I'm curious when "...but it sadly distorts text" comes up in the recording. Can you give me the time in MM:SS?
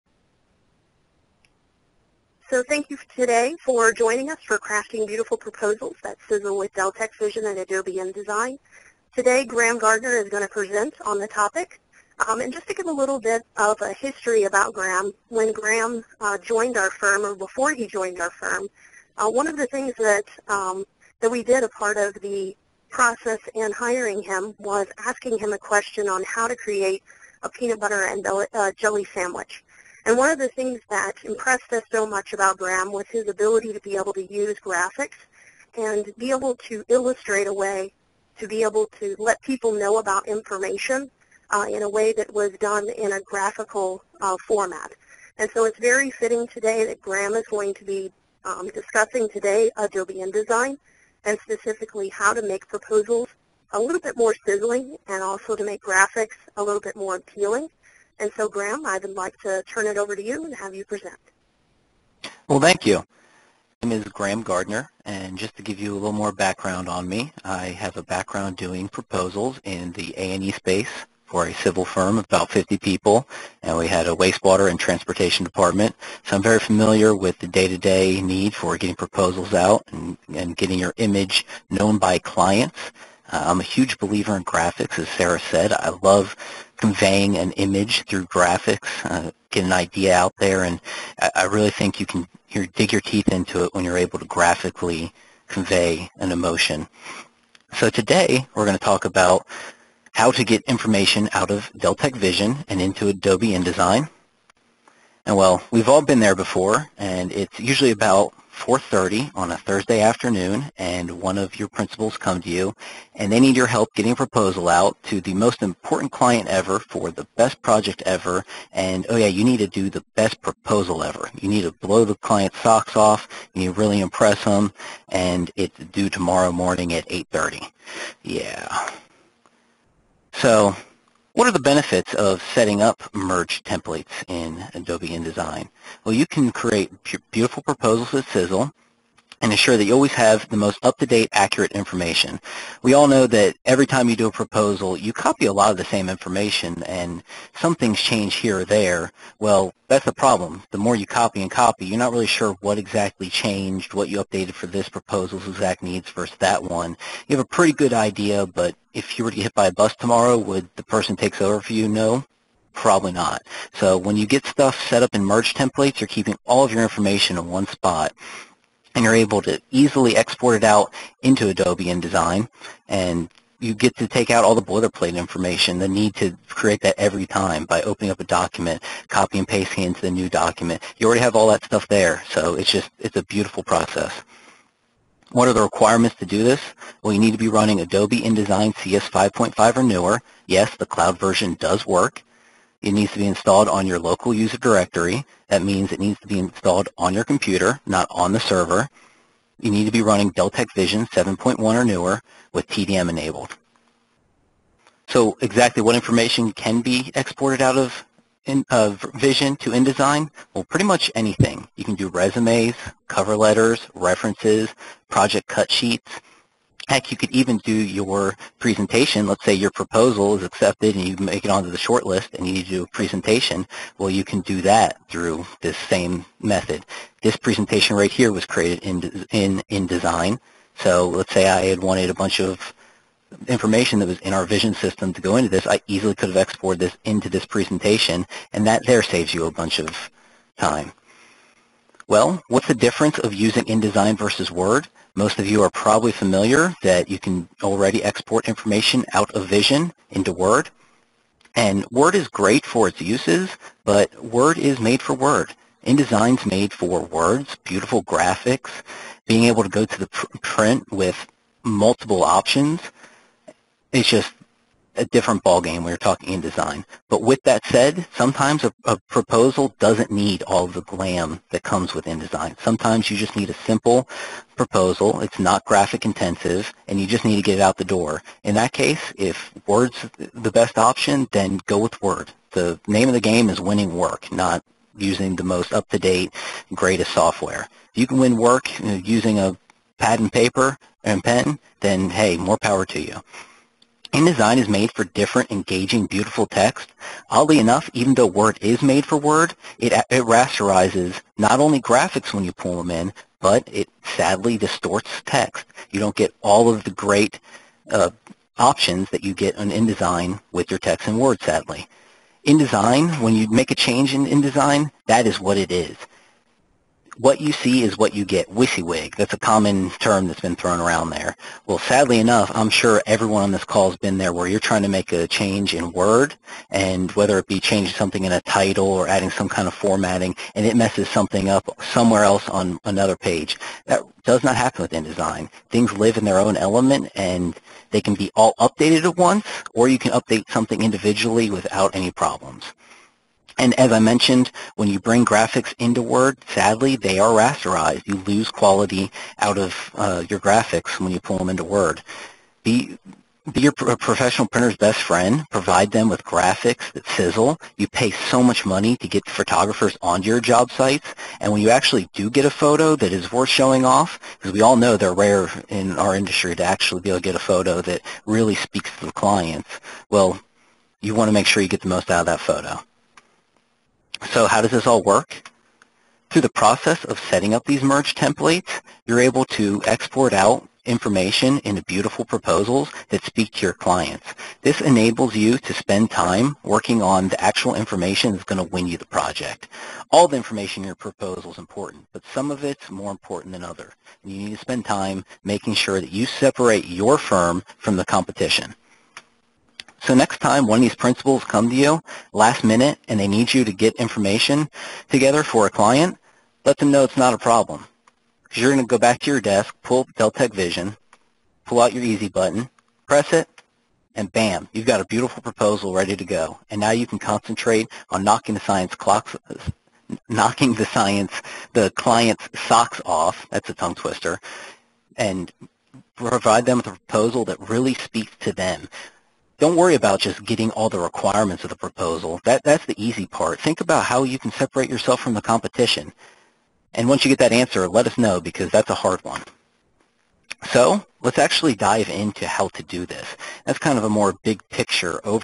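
05:03.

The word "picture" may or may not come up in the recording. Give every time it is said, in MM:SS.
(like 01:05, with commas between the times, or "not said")
07:24.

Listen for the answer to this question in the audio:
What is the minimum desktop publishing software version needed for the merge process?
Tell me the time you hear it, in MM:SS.
03:08.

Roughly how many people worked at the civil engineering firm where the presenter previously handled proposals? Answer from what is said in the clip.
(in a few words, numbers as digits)
50.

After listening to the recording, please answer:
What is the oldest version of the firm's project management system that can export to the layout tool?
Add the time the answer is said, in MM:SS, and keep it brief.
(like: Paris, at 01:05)
7.1, at 03:21.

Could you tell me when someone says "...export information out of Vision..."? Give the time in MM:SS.
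04:08.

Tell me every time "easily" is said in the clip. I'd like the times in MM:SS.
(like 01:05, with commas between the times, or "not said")
02:49, 03:55.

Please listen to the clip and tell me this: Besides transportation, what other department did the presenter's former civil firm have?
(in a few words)
Wastewater.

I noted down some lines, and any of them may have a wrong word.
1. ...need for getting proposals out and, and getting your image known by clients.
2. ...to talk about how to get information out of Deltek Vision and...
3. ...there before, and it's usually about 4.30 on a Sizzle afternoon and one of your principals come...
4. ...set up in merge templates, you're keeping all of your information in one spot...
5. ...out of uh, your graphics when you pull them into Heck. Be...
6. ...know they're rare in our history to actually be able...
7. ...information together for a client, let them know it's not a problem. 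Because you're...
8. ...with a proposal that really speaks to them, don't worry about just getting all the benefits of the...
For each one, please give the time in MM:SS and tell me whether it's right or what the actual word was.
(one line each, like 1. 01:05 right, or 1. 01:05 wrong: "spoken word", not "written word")
1. 01:18 right
2. 01:38 right
3. 01:46 wrong: "Thursday", not "Sizzle"
4. 02:44 right
5. 05:49 wrong: "Word", not "Heck"
6. 06:04 wrong: "industry", not "history"
7. 06:43 right
8. 07:06 wrong: "requirements", not "benefits".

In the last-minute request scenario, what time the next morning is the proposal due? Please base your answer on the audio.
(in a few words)
8:30.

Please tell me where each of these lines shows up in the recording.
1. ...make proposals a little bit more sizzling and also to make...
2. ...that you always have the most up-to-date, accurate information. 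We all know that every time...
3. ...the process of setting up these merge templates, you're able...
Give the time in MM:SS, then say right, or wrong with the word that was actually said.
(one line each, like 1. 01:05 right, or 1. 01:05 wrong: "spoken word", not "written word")
1. 00:52 right
2. 02:19 right
3. 06:16 right.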